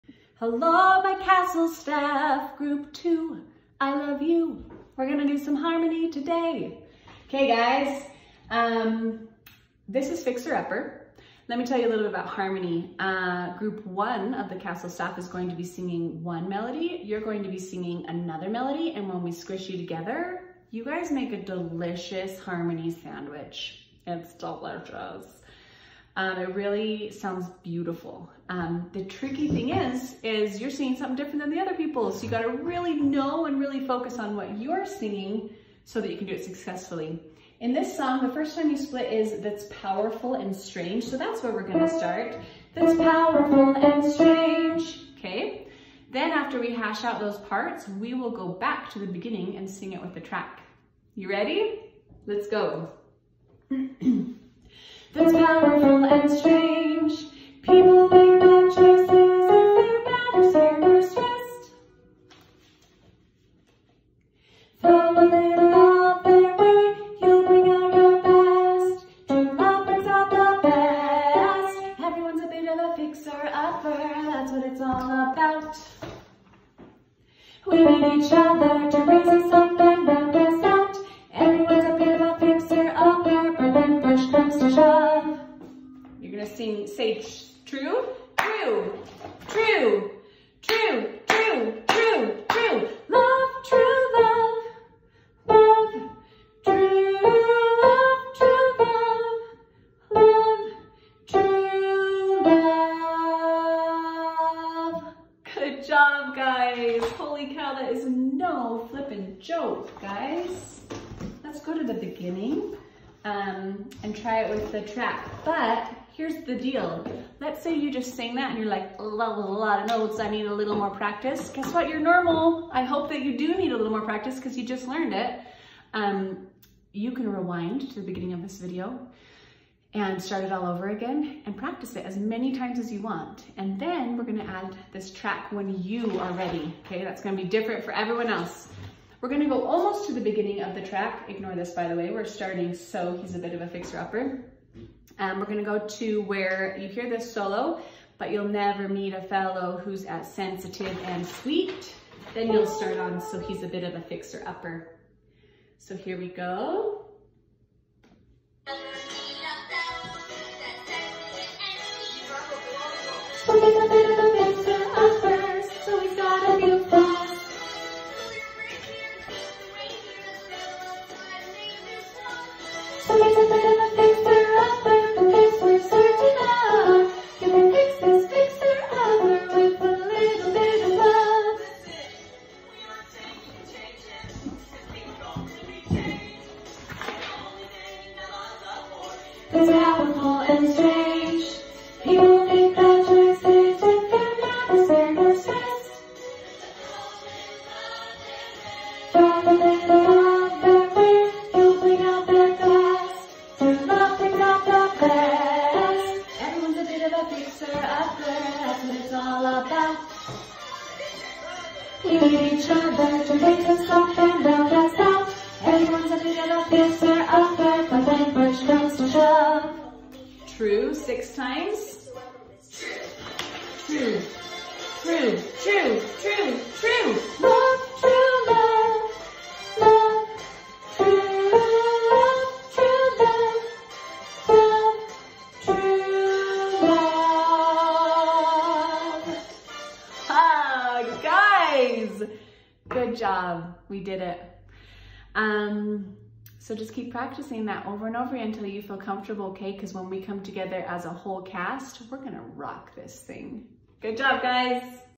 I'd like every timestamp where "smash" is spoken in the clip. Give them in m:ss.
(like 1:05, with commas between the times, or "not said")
not said.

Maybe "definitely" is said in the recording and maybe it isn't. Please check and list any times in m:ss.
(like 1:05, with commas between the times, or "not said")
not said.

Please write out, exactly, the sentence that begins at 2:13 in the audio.
And then we're gonna add this track when you are ready, okay?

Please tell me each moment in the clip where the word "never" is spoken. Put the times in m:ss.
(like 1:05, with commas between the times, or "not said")
2:28.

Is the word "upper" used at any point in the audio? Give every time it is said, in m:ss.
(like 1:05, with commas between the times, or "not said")
0:10, 1:12, 2:23, 2:34.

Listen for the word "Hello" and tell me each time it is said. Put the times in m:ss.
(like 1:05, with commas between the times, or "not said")
0:00.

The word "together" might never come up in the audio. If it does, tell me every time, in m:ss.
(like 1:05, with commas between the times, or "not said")
0:19, 4:10.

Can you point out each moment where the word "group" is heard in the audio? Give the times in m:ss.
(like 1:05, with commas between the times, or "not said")
0:02, 0:13.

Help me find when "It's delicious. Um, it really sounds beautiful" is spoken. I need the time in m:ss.
0:24.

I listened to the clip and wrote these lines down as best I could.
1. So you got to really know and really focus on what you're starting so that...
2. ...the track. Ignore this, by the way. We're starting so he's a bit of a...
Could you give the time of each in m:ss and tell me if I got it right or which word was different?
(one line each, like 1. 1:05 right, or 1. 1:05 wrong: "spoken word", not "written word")
1. 0:32 wrong: "singing", not "starting"
2. 2:20 right.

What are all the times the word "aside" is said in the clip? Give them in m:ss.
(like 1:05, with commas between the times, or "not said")
not said.